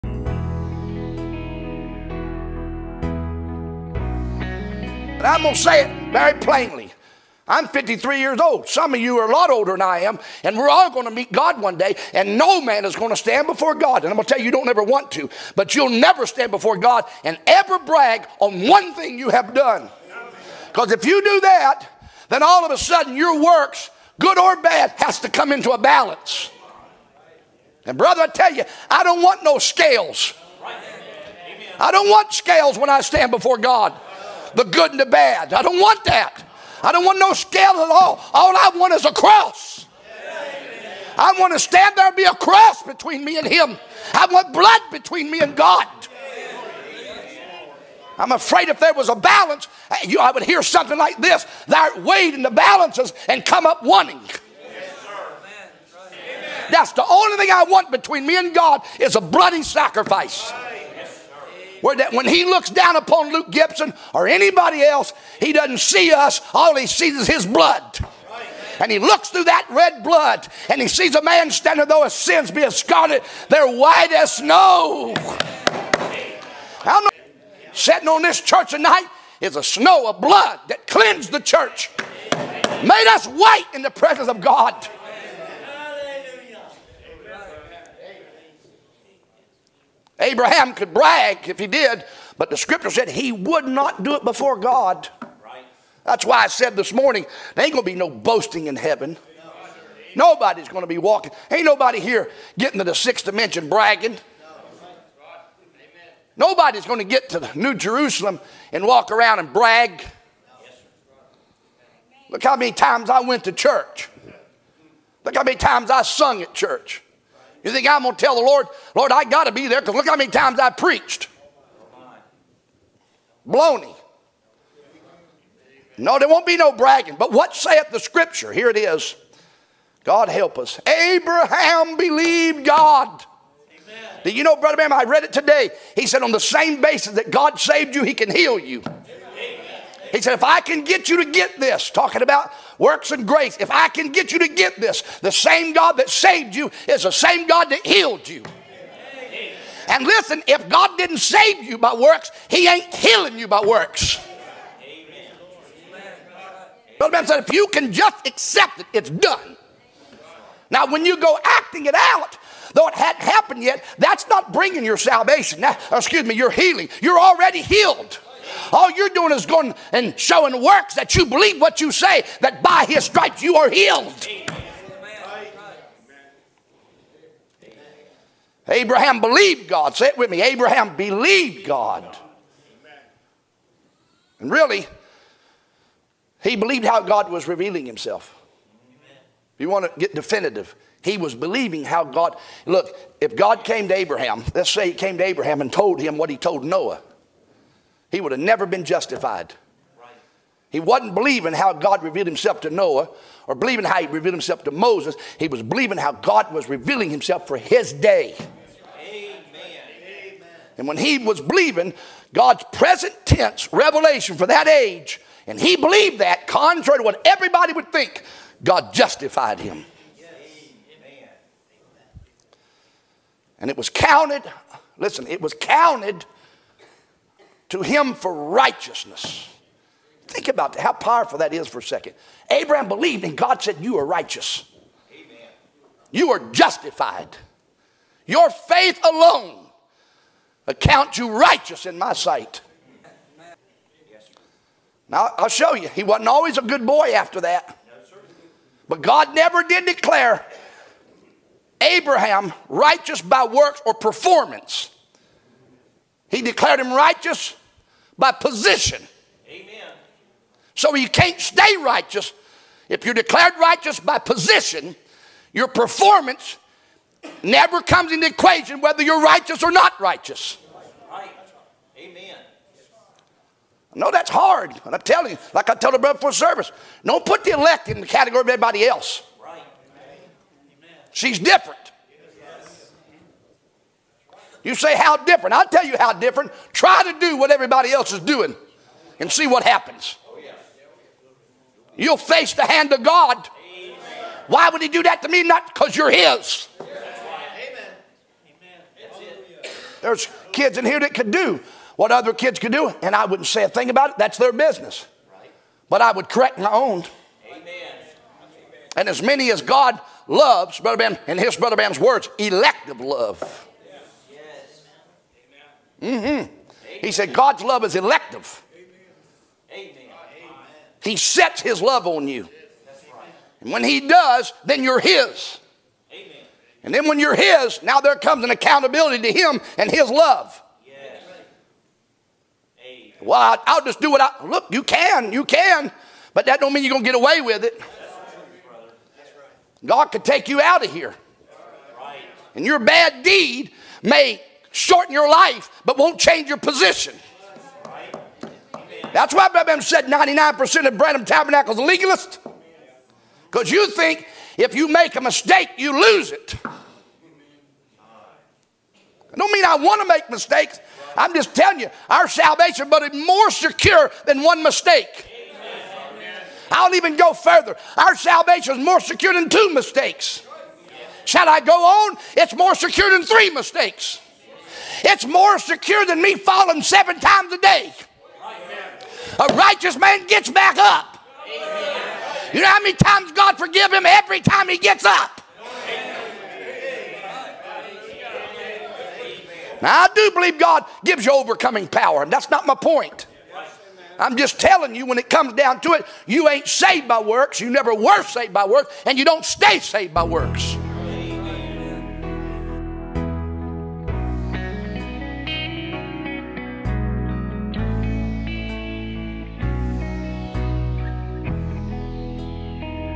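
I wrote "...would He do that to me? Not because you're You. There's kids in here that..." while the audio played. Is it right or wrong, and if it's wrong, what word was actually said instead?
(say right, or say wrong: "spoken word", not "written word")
wrong: "His", not "You".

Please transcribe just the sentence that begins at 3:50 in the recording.
Think about that, how powerful that is for a second.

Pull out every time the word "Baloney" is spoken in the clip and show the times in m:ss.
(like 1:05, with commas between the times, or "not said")
2:03.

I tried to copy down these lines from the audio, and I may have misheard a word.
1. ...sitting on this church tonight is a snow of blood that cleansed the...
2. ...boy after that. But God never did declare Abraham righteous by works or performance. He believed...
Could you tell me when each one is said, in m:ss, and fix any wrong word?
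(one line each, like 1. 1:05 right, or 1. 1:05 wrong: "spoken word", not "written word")
1. 1:17 right
2. 4:06 wrong: "declared", not "believed".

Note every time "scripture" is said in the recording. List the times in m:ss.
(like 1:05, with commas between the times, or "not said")
1:32, 2:07.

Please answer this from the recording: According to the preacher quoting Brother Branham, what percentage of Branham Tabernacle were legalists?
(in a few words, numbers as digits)
99%.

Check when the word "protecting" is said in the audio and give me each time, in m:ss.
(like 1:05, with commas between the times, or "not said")
not said.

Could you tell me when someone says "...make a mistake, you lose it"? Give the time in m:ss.
5:54.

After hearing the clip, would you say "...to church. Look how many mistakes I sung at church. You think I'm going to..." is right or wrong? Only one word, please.
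wrong.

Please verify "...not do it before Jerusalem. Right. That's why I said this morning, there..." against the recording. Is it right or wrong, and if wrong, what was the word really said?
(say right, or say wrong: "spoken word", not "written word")
wrong: "God", not "Jerusalem".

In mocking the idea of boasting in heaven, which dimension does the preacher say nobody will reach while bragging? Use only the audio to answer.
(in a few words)
Sixth dimension.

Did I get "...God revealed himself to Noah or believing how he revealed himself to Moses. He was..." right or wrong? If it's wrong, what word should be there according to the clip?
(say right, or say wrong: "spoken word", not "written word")
right.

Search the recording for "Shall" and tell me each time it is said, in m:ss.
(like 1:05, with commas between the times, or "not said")
6:11.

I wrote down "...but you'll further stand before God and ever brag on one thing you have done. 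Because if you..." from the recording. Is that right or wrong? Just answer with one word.
wrong.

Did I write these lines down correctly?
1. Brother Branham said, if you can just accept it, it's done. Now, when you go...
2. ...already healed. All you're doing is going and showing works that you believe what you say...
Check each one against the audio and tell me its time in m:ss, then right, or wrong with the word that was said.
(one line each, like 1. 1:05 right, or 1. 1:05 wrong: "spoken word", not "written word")
1. 2:36 right
2. 2:47 right.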